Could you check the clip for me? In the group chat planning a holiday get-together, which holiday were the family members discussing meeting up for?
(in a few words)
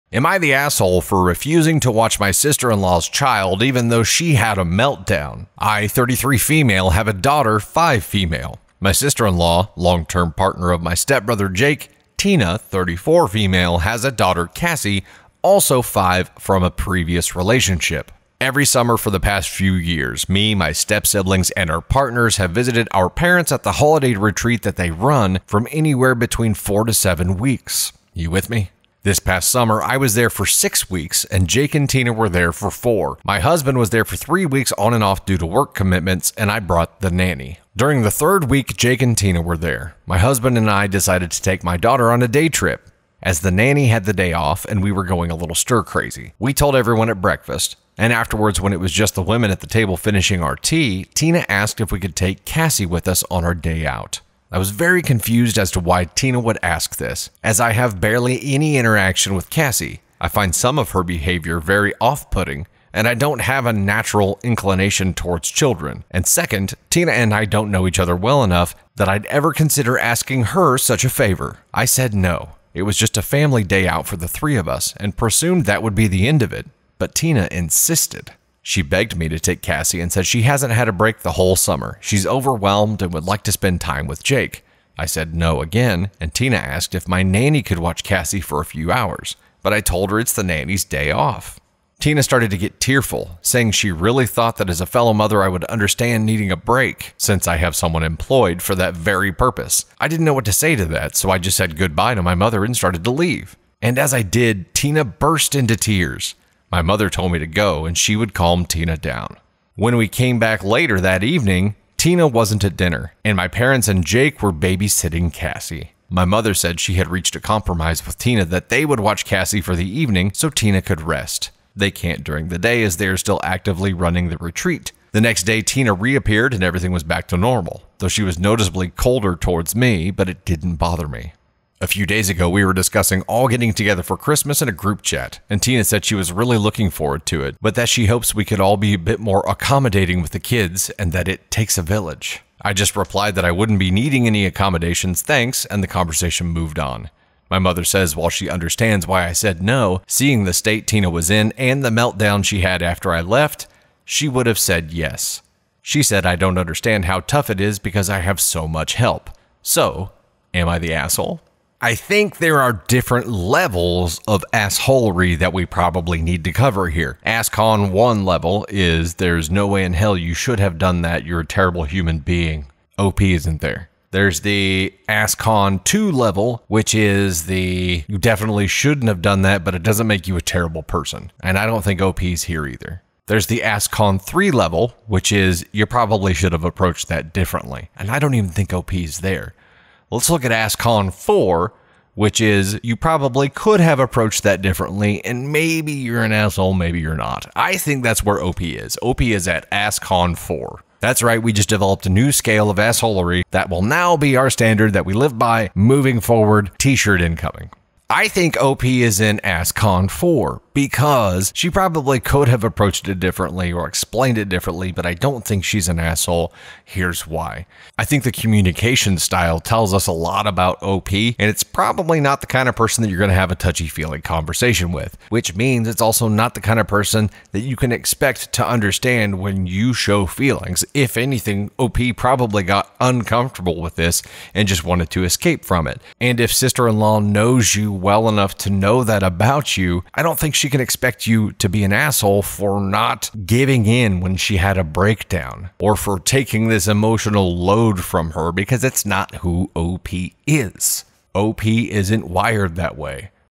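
Christmas.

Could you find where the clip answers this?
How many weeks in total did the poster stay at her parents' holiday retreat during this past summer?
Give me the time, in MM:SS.
00:30.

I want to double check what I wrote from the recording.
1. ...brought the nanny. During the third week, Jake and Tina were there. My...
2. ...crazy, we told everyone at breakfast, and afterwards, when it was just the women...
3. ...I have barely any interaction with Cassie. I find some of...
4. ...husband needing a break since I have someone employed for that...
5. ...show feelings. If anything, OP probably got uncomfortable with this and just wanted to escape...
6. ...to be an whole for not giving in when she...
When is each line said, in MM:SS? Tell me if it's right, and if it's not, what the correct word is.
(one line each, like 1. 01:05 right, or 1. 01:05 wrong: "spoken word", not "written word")
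1. 00:36 right
2. 00:45 right
3. 00:57 right
4. 01:35 wrong: "understand", not "husband"
5. 03:49 right
6. 04:01 wrong: "asshole", not "whole".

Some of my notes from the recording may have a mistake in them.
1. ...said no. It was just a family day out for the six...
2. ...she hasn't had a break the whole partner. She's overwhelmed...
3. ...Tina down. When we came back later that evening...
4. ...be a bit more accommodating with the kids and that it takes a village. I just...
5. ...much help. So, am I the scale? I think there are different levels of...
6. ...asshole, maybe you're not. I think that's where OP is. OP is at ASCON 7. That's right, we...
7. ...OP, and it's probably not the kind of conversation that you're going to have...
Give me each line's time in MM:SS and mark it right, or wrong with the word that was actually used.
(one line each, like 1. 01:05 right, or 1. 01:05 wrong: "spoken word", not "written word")
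1. 01:11 wrong: "three", not "six"
2. 01:20 wrong: "summer", not "partner"
3. 01:48 right
4. 02:18 right
5. 02:38 wrong: "asshole", not "scale"
6. 03:16 wrong: "4", not "7"
7. 03:40 wrong: "person", not "conversation".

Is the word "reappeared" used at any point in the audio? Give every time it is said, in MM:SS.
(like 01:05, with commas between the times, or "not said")
02:05.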